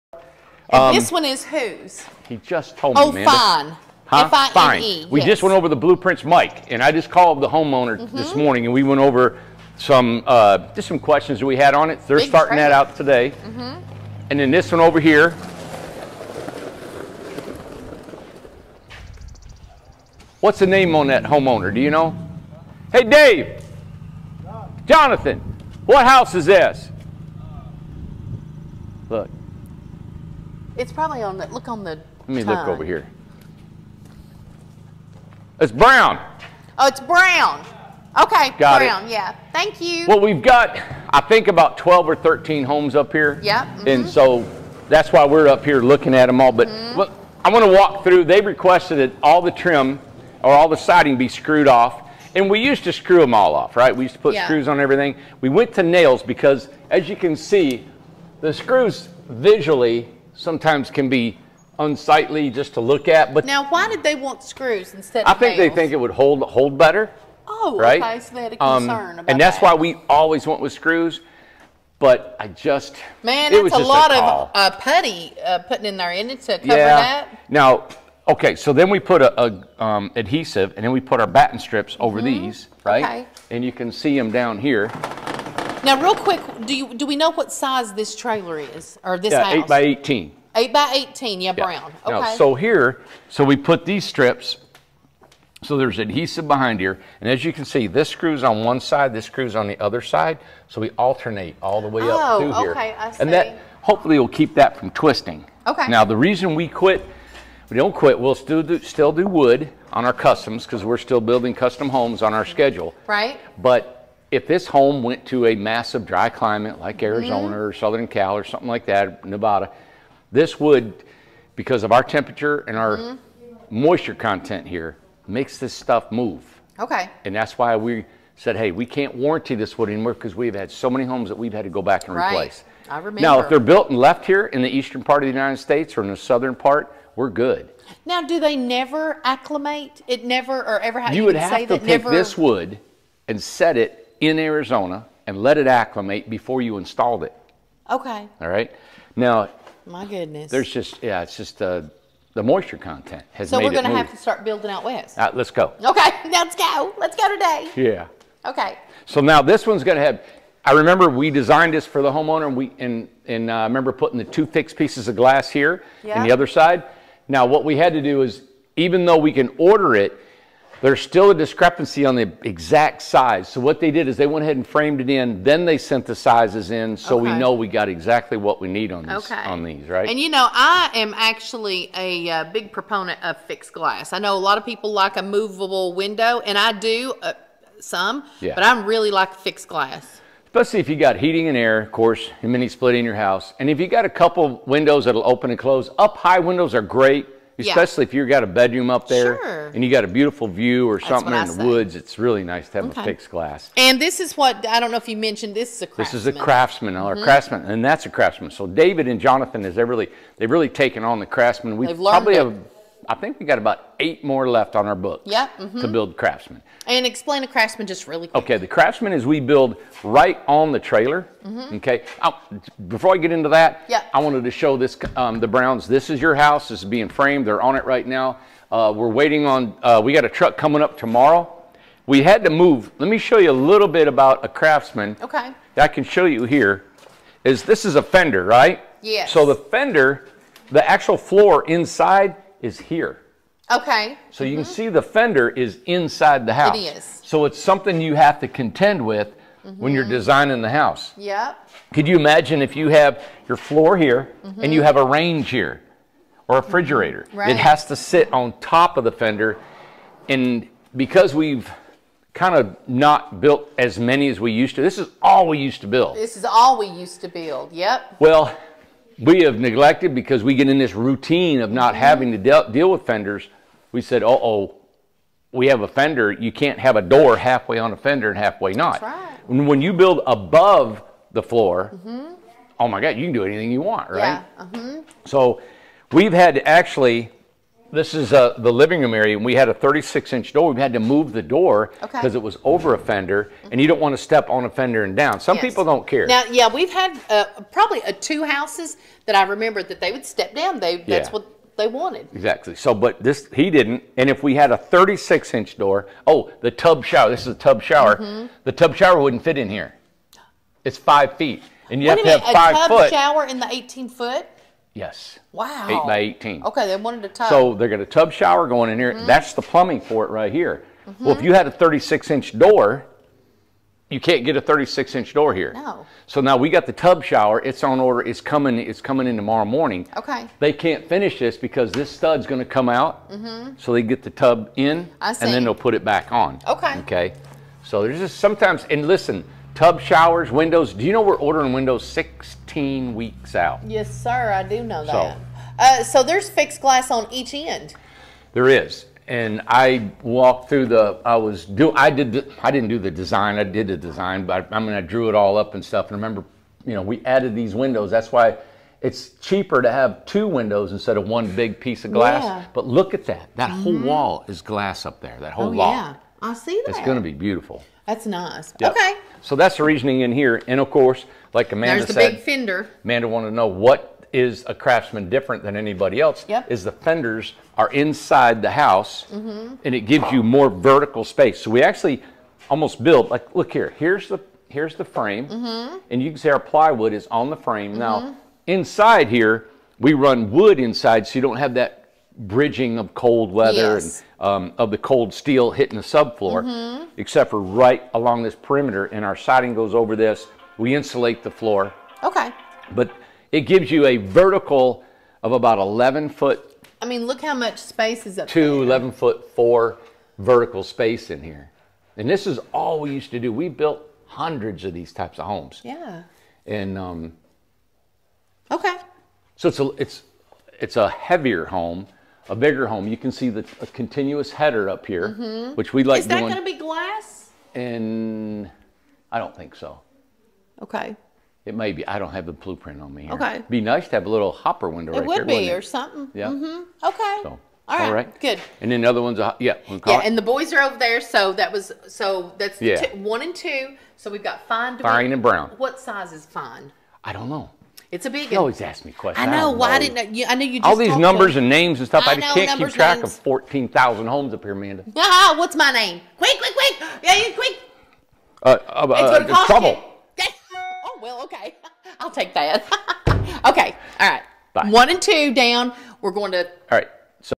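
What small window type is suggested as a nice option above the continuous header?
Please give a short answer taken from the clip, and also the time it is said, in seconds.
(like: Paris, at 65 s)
Hopper window, at 434 s.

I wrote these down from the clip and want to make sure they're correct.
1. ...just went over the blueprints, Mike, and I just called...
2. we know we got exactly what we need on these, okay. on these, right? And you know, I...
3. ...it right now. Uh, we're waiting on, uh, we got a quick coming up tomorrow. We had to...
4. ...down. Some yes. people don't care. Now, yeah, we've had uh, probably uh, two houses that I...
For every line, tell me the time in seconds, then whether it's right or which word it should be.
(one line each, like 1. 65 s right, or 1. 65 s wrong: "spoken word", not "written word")
1. 5 s right
2. 177 s right
3. 227 s wrong: "truck", not "quick"
4. 295 s right.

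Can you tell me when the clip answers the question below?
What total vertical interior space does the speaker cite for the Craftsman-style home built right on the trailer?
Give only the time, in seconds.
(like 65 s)
408 s.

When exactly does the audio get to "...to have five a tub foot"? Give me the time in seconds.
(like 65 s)
312 s.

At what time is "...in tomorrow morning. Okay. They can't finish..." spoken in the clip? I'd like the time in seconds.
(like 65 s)
329 s.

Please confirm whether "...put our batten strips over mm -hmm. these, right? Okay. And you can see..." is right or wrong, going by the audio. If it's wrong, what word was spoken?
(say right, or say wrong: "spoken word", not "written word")
right.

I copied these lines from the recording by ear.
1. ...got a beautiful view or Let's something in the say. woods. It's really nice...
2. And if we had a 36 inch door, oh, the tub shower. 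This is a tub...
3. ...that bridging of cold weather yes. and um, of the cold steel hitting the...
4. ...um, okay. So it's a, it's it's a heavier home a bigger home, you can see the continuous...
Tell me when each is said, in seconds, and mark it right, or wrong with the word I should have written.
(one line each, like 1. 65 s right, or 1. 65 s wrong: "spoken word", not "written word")
1. 199 s wrong: "That", not "Let"
2. 304 s right
3. 391 s right
4. 416 s right.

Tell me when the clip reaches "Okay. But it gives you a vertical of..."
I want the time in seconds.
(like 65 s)
402 s.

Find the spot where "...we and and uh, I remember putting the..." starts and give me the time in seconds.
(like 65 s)
162 s.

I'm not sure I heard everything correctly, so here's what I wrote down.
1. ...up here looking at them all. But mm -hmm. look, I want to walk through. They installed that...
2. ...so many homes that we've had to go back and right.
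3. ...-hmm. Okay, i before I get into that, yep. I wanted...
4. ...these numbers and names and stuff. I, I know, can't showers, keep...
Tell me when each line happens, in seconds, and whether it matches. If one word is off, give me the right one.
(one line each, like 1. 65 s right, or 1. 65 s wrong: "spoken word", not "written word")
1. 45 s wrong: "requested", not "installed"
2. 130 s right
3. 221 s right
4. 450 s wrong: "numbers", not "showers".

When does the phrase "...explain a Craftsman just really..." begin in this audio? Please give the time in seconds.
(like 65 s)
217 s.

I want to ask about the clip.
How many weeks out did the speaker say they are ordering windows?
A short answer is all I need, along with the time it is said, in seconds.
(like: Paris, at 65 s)
16 weeks, at 342 s.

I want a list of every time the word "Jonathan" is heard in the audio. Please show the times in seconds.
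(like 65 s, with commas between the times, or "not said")
24 s, 209 s.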